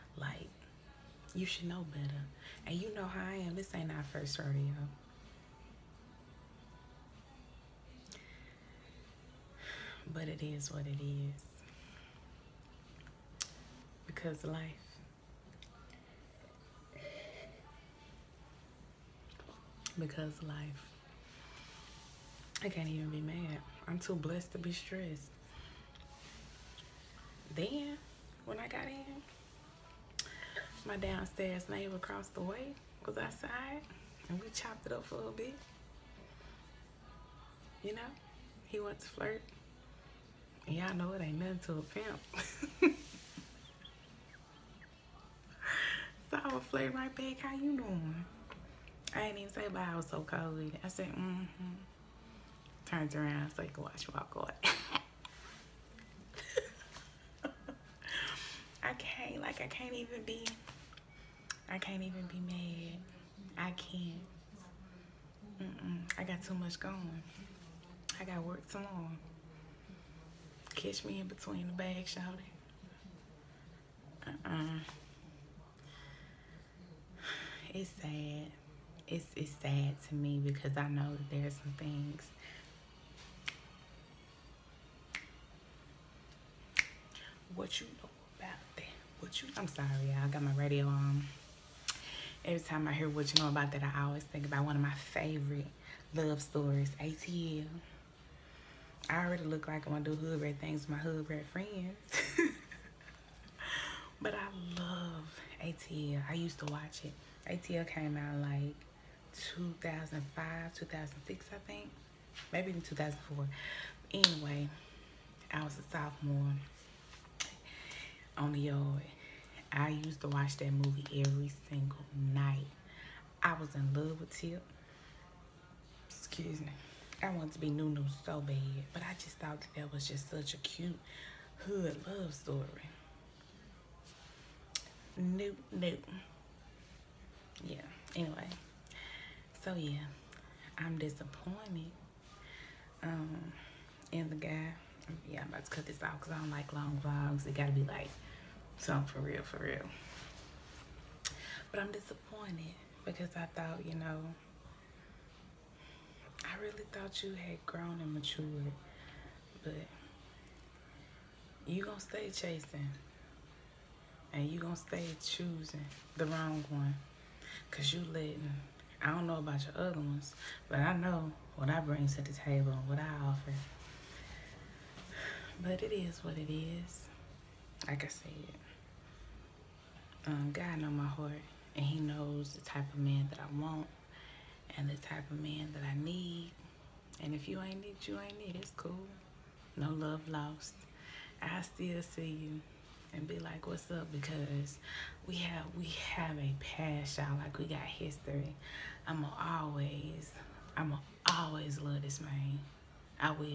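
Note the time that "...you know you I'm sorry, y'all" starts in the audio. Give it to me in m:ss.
1:27.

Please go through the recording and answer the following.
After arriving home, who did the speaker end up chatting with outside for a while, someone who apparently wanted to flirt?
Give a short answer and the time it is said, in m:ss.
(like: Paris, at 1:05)
downstairs neighbor, at 0:30.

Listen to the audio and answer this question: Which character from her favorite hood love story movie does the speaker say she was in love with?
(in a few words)
Tip.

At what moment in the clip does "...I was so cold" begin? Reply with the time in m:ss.
0:49.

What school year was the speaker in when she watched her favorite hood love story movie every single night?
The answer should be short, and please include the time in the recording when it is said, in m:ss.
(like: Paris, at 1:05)
sophomore, at 1:55.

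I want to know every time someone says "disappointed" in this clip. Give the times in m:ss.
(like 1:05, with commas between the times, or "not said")
2:20, 2:31.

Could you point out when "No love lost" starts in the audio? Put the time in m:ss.
3:09.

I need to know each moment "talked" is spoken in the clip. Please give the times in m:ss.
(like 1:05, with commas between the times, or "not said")
not said.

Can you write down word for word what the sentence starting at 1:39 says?
I already look like I'm gonna do hood red things with my hood red friends.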